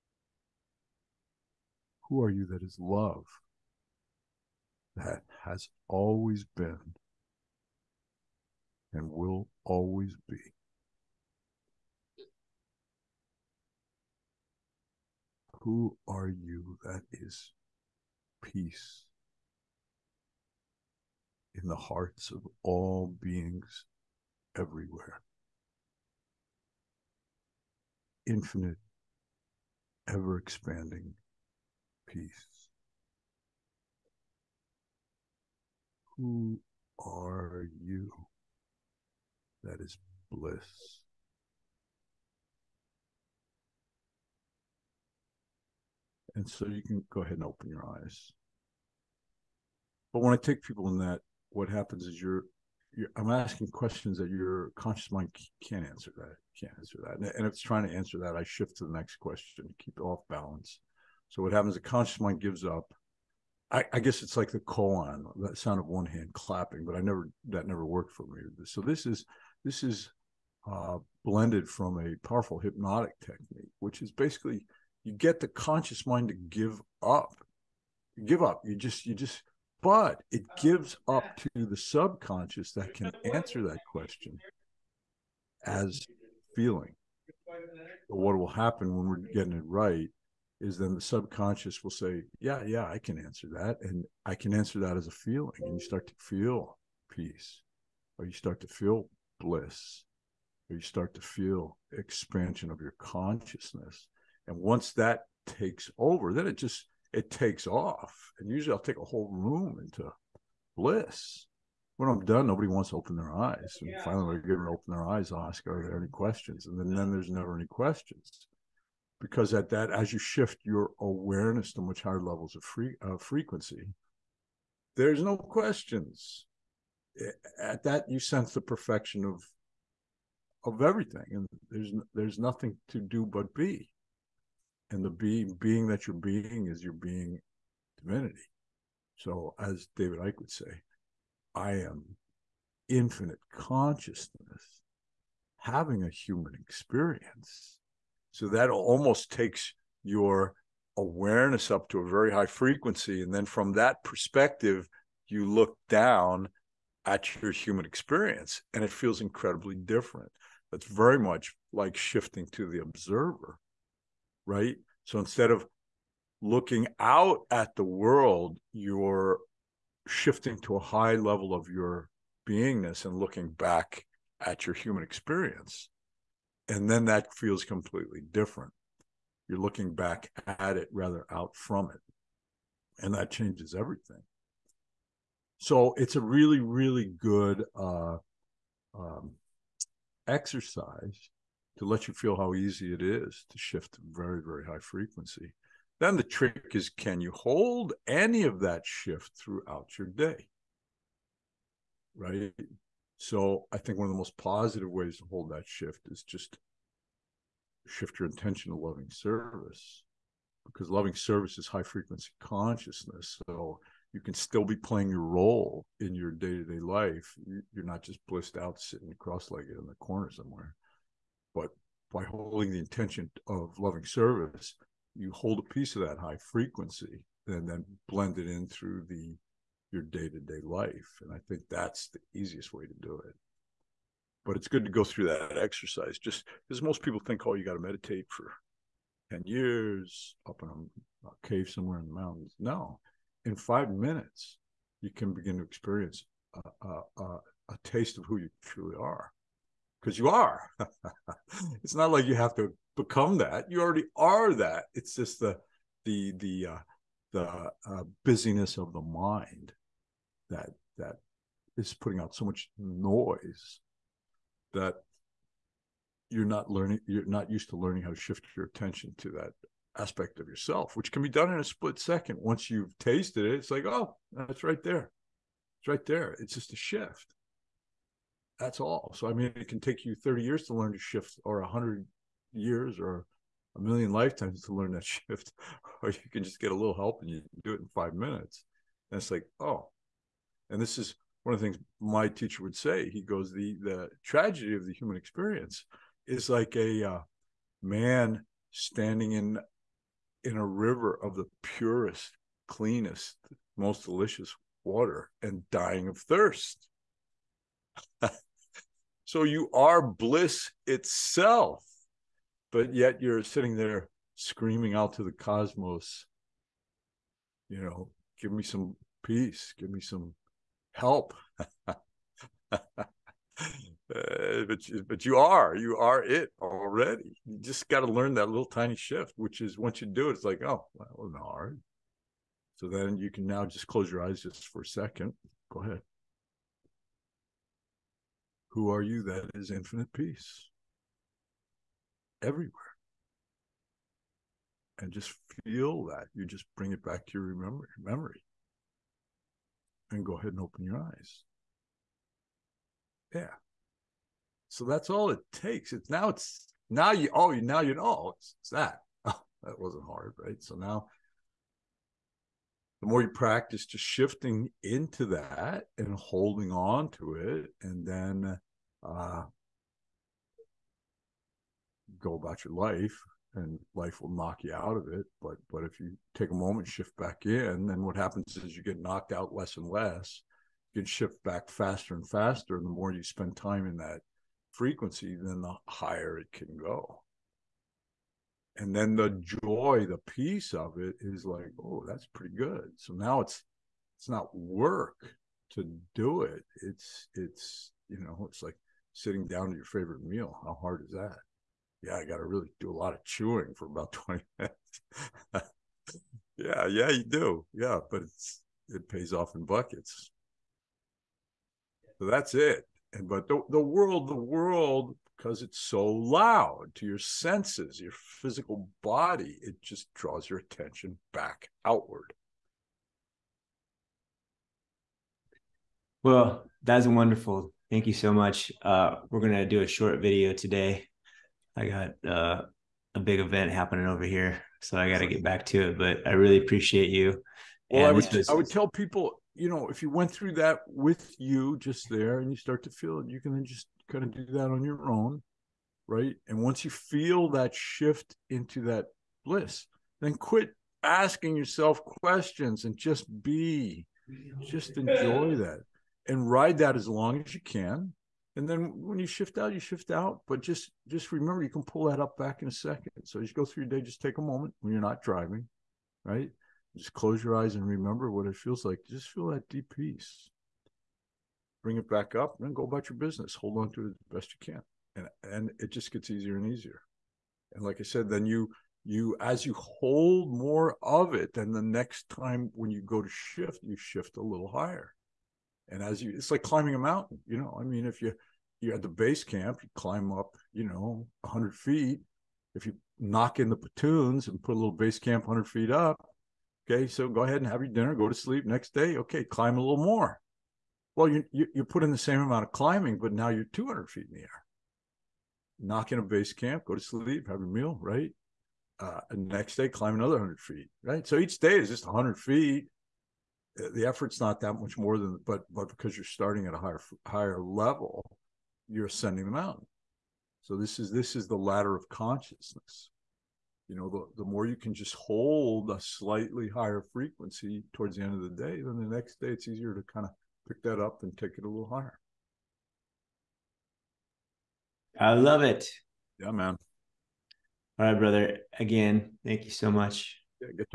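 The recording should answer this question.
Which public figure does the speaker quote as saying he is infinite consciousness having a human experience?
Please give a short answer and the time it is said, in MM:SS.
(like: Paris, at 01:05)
David Icke, at 02:19.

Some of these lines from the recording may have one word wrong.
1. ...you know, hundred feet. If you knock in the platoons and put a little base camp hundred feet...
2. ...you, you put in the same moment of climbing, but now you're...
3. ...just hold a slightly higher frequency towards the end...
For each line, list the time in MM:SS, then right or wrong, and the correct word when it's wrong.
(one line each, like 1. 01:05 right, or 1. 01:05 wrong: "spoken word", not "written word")
1. 08:10 right
2. 08:21 wrong: "amount", not "moment"
3. 08:44 right.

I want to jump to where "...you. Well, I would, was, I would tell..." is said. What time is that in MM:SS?
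07:17.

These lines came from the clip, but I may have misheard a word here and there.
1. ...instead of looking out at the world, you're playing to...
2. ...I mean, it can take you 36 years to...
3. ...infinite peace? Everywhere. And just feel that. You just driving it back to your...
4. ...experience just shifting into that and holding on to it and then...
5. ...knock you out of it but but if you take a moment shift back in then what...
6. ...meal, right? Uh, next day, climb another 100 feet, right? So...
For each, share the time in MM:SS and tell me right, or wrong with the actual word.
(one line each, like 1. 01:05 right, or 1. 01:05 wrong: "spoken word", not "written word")
1. 02:45 wrong: "shifting", not "playing"
2. 04:39 wrong: "30", not "36"
3. 05:39 wrong: "bring", not "driving"
4. 06:03 wrong: "practice", not "experience"
5. 06:14 right
6. 08:27 right.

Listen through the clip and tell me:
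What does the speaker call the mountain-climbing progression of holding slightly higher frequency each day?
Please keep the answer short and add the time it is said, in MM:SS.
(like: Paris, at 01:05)
the ladder of consciousness, at 08:41.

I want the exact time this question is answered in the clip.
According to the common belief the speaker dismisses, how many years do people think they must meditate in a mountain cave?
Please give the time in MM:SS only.
03:59.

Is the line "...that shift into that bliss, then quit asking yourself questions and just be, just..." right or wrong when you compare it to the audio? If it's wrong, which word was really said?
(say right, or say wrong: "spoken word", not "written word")
right.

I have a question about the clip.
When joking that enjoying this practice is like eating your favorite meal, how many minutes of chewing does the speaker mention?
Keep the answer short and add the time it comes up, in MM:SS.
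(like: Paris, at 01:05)
20, at 06:44.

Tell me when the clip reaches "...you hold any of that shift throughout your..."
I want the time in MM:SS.
03:17.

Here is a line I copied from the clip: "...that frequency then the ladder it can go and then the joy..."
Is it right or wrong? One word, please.
wrong.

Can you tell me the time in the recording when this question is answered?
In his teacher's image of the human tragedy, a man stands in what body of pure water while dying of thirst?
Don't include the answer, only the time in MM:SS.
05:00.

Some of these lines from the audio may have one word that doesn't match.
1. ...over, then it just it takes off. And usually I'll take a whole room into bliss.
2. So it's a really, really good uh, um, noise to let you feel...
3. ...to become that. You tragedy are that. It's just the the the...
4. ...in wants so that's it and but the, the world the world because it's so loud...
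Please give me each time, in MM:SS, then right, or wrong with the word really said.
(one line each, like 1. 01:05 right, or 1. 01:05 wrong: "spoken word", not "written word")
1. 01:45 right
2. 03:05 wrong: "exercise", not "noise"
3. 04:12 wrong: "already", not "tragedy"
4. 06:49 wrong: "buckets", not "wants".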